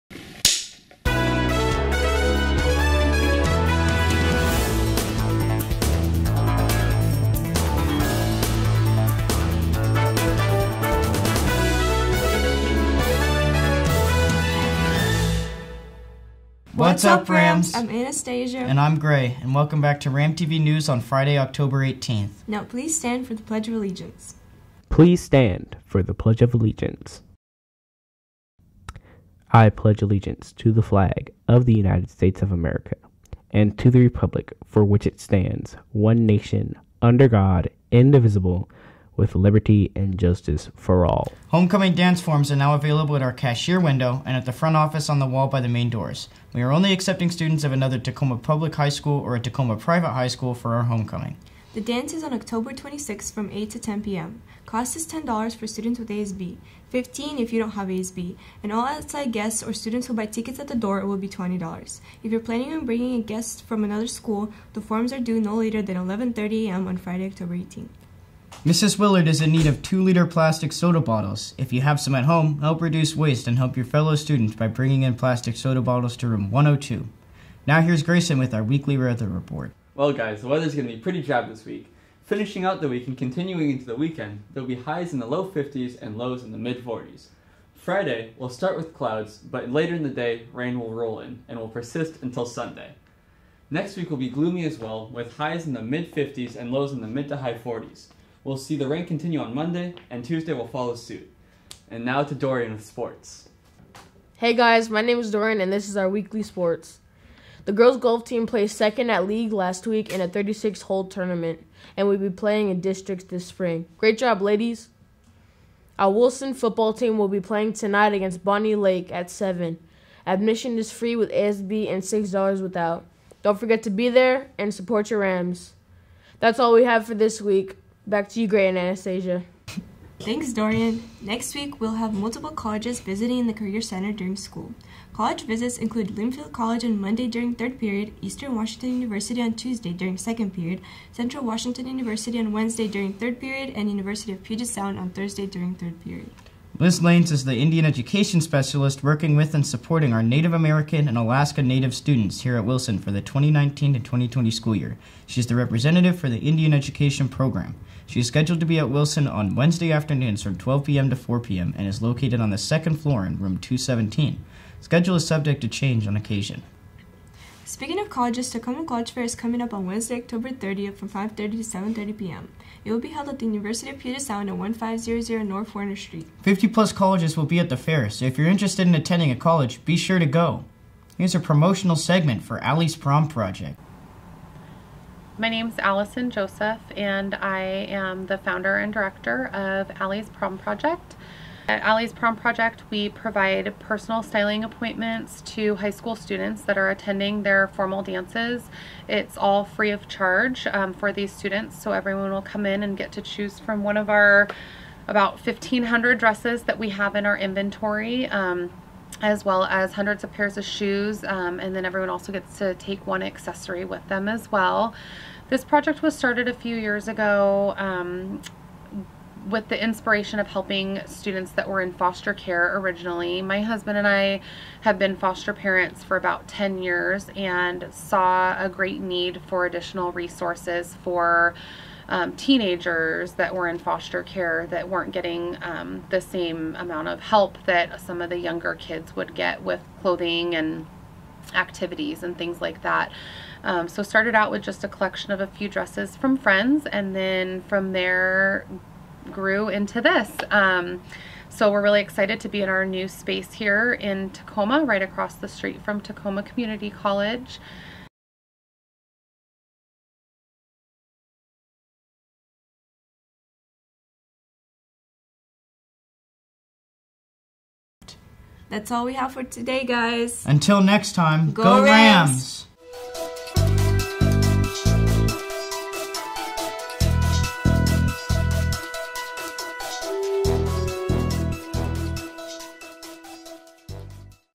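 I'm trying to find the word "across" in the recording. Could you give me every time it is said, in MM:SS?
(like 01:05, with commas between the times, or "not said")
04:15.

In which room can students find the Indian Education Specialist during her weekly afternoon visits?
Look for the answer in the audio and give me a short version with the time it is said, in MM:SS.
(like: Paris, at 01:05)
217, at 02:43.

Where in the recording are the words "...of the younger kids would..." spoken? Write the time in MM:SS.
03:58.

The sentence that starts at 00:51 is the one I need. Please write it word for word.
The dance is on October 26th from 8 to 10 p.m.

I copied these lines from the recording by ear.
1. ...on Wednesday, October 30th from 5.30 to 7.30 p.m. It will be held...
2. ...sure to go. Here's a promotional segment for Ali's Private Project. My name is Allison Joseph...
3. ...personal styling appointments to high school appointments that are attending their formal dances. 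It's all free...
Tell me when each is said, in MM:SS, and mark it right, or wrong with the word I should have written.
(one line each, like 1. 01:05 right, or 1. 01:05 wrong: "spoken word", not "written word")
1. 02:49 right
2. 02:59 wrong: "Prom", not "Private"
3. 03:13 wrong: "students", not "appointments".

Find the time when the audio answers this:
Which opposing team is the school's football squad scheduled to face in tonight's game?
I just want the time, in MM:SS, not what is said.
01:58.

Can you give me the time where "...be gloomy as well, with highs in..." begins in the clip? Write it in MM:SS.
01:34.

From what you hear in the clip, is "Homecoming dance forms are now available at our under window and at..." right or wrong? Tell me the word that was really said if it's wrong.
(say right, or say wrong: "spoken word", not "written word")
wrong: "cashier", not "under".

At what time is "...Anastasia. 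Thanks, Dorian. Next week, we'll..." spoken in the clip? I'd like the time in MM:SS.
02:08.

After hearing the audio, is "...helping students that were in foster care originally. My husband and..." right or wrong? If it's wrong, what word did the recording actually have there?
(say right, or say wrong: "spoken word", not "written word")
right.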